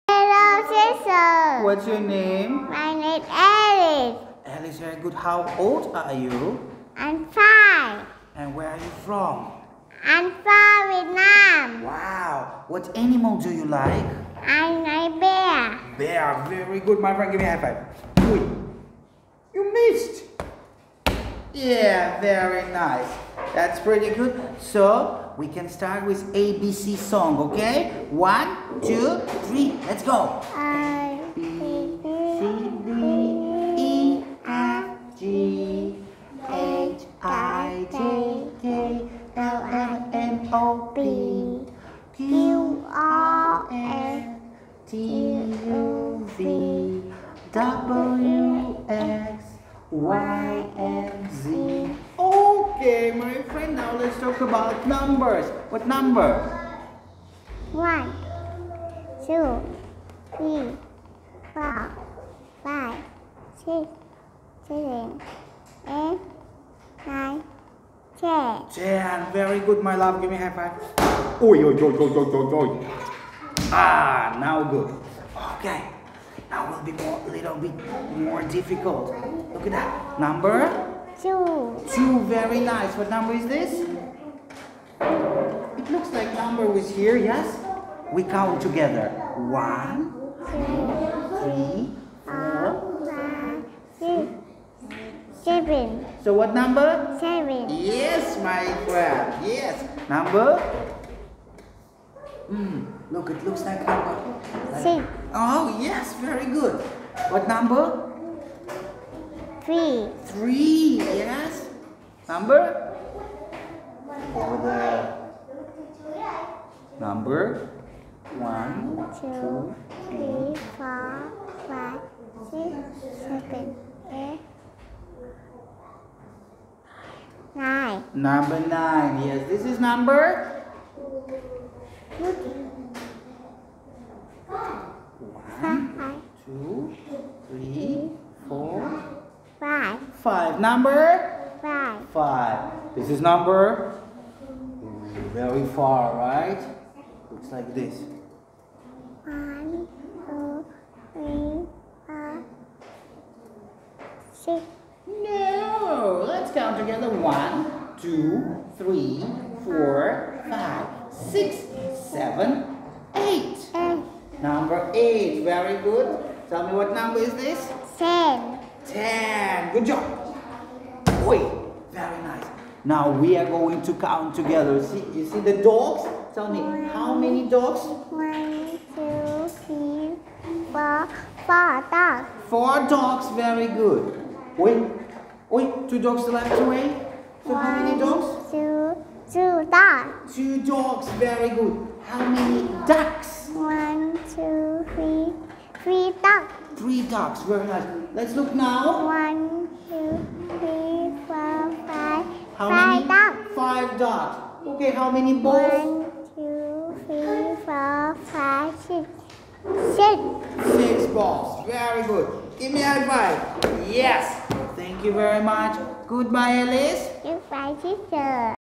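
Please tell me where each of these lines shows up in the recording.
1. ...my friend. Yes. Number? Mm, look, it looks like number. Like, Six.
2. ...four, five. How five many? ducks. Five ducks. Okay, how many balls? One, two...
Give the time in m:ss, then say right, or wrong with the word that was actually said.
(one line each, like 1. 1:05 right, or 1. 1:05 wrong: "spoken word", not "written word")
1. 1:38 right
2. 3:21 right.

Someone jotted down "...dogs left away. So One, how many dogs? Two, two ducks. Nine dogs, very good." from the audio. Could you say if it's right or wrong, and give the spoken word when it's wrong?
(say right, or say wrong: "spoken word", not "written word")
wrong: "Two", not "Nine".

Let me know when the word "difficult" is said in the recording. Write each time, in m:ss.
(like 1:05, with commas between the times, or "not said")
1:18.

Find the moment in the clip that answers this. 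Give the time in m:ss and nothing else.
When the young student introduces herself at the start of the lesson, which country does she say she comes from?
0:10.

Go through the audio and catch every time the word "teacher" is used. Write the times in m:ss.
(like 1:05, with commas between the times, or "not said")
3:37.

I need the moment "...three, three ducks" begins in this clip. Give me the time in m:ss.
3:14.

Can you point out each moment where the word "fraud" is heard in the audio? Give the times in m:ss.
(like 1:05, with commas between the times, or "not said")
not said.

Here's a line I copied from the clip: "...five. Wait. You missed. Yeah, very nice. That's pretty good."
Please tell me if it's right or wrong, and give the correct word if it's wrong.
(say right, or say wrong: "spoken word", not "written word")
right.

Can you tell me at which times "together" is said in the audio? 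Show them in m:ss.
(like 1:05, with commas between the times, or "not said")
1:28, 2:54.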